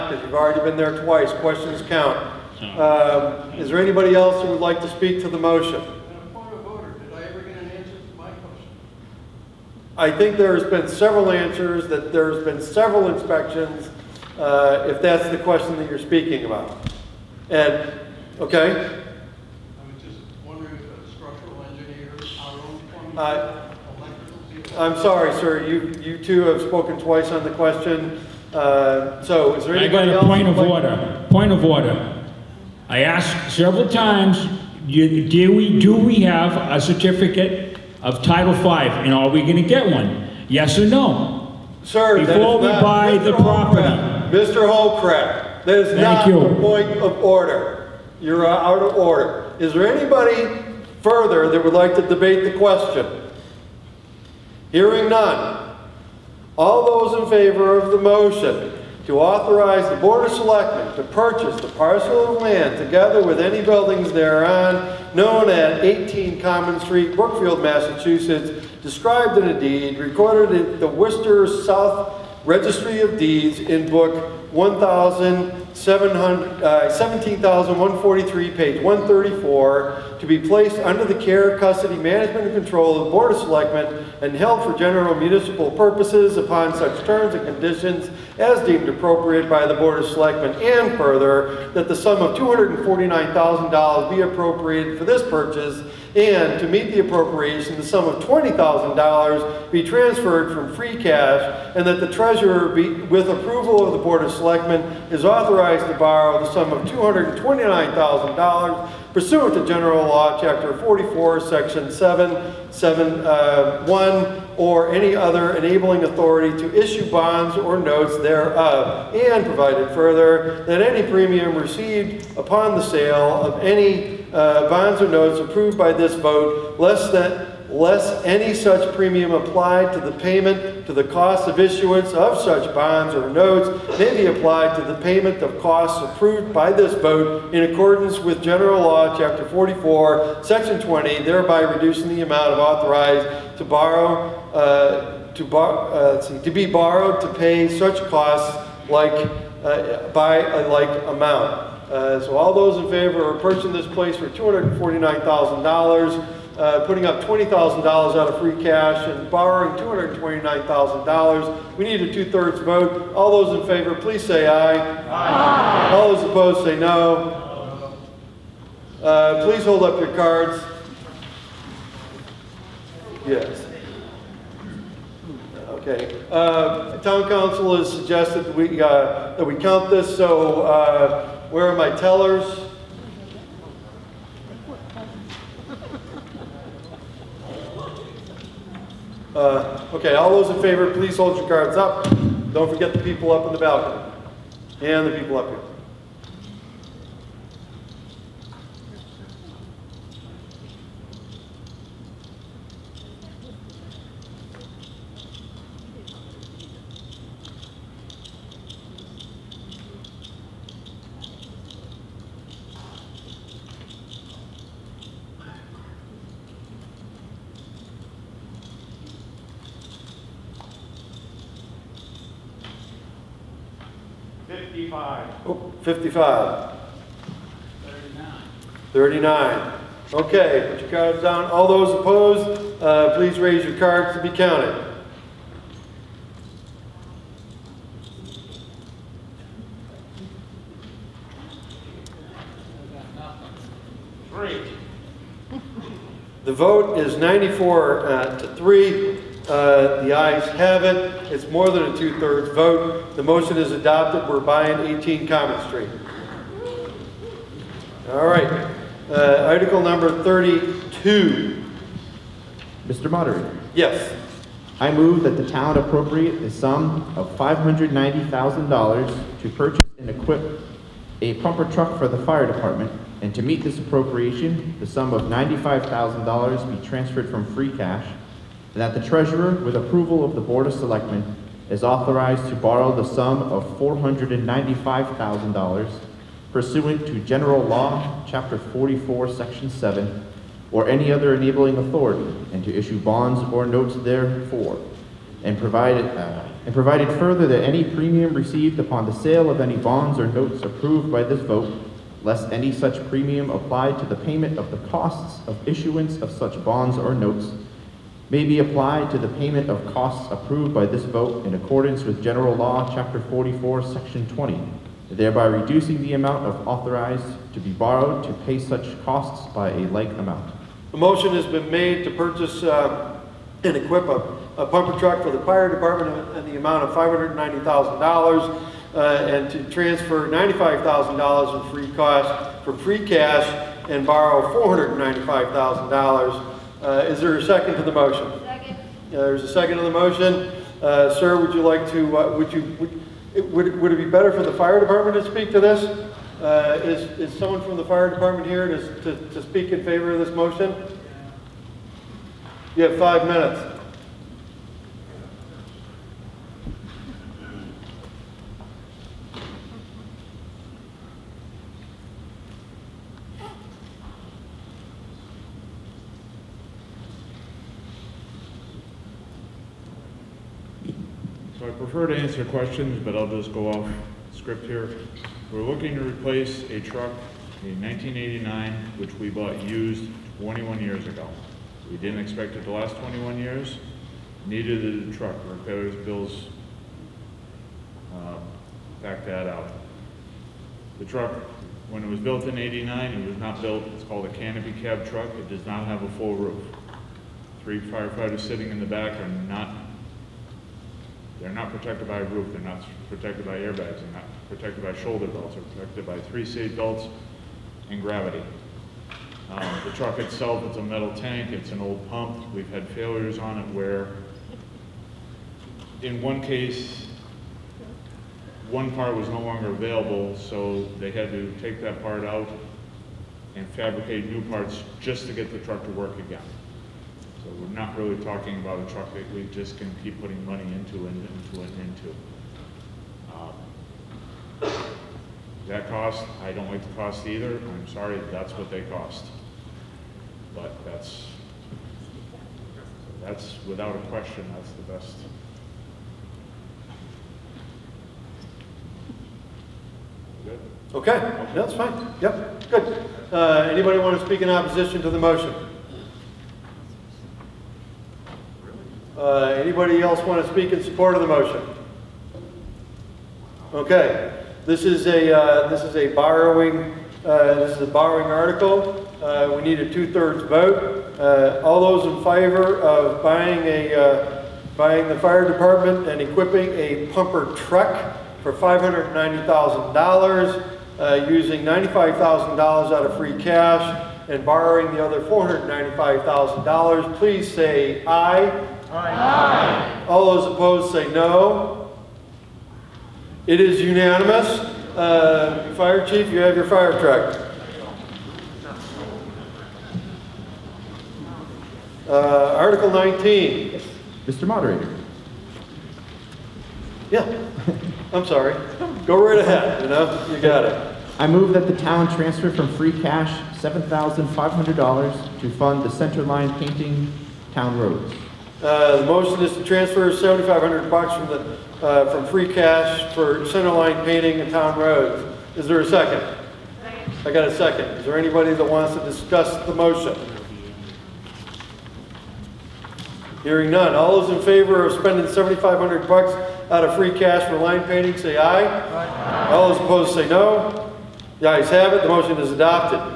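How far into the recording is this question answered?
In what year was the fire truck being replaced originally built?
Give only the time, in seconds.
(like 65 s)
377 s.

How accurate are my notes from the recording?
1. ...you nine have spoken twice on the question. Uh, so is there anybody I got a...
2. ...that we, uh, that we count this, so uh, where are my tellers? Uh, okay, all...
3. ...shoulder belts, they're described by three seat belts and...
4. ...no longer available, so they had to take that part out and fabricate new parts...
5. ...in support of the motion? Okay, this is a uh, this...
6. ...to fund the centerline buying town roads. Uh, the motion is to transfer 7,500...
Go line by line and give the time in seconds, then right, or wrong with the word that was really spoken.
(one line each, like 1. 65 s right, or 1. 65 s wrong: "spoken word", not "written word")
1. 26 s wrong: "two", not "nine"
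2. 178 s right
3. 404 s wrong: "protected", not "described"
4. 419 s right
5. 460 s right
6. 515 s wrong: "painting", not "buying".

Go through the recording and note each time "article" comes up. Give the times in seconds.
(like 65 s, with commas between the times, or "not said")
259 s, 468 s, 502 s.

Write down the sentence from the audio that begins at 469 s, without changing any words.
Uh, we need a two-thirds vote.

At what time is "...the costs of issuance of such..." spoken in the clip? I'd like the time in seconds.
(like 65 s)
304 s.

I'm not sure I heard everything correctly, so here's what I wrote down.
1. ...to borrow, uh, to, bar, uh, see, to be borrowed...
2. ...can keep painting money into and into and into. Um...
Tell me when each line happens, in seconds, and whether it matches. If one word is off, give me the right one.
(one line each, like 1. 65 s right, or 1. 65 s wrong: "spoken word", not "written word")
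1. 143 s right
2. 429 s wrong: "putting", not "painting".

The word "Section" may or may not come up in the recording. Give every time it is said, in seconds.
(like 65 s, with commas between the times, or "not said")
111 s, 140 s, 289 s, 313 s.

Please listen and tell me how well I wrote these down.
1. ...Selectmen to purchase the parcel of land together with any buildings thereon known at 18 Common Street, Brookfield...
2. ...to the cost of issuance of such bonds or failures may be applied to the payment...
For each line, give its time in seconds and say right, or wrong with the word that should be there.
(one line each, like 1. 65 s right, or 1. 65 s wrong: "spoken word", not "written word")
1. 60 s right
2. 130 s wrong: "notes", not "failures".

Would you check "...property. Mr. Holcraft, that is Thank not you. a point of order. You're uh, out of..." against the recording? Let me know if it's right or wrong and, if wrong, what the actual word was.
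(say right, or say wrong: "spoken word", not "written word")
right.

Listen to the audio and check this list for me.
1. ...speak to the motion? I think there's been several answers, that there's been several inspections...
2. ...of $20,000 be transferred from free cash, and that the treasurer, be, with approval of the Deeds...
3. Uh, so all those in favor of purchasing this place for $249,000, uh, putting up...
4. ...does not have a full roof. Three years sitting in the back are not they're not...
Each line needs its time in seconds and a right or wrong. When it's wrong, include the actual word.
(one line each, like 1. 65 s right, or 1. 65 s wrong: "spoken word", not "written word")
1. 4 s right
2. 98 s wrong: "Board", not "Deeds"
3. 151 s right
4. 395 s wrong: "firefighters", not "years".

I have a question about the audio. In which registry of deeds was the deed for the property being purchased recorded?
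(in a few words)
Worcester South Registry of Deeds.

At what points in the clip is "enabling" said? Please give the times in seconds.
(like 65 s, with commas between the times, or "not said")
115 s, 291 s.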